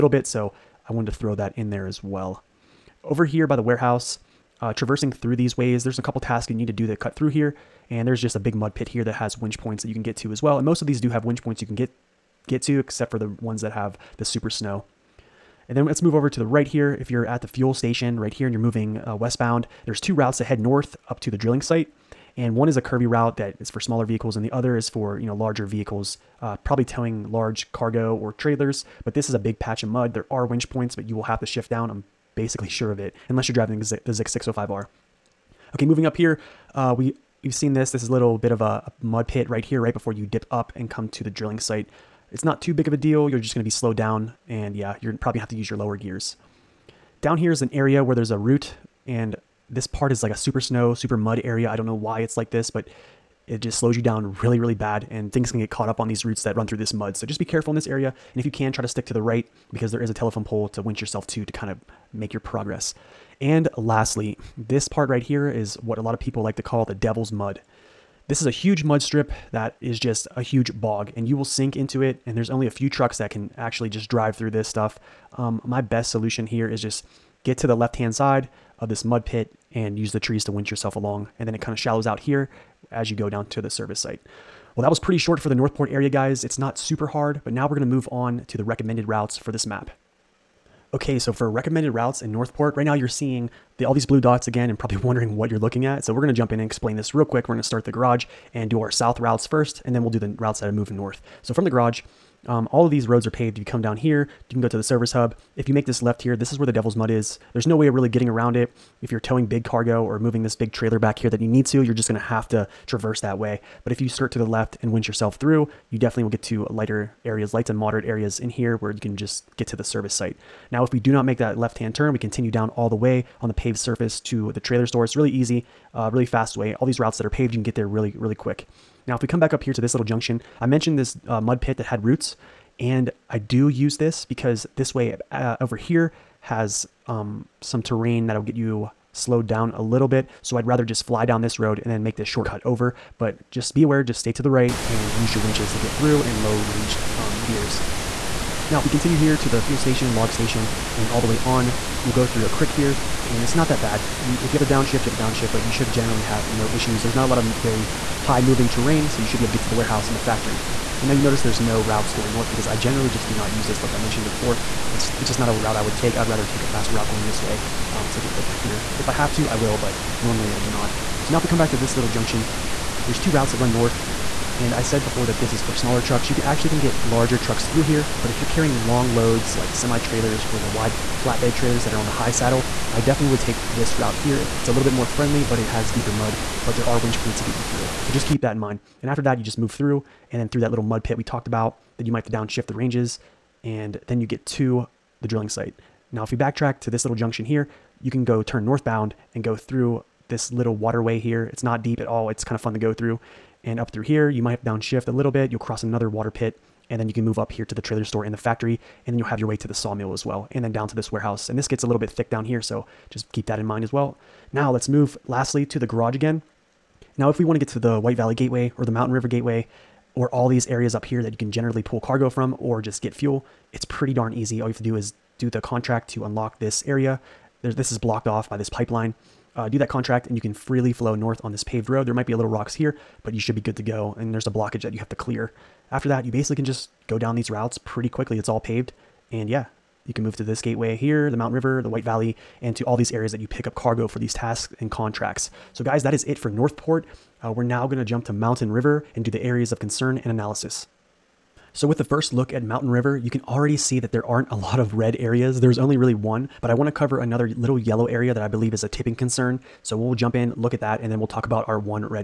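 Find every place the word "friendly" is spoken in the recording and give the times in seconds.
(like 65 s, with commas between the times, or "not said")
185 s.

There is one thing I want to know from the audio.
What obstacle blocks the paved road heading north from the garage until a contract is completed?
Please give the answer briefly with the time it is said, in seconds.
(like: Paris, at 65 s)
pipeline, at 228 s.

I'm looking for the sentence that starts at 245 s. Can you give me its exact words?
So guys, that is it for Northport.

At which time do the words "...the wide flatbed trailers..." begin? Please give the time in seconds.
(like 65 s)
180 s.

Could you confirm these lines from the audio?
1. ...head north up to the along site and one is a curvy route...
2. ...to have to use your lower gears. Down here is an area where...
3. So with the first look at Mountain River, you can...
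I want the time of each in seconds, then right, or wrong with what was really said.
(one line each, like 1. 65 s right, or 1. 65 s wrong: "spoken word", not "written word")
1. 20 s wrong: "drilling", not "along"
2. 45 s right
3. 251 s right.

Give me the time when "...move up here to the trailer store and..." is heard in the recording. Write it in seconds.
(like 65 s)
207 s.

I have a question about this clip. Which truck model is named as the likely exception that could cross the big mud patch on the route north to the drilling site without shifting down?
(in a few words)
ZiKZ 605R.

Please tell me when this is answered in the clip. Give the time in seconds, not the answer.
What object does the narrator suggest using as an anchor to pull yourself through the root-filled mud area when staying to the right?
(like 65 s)
60 s.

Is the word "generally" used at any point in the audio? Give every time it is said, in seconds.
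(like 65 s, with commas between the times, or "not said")
155 s, 162 s, 221 s.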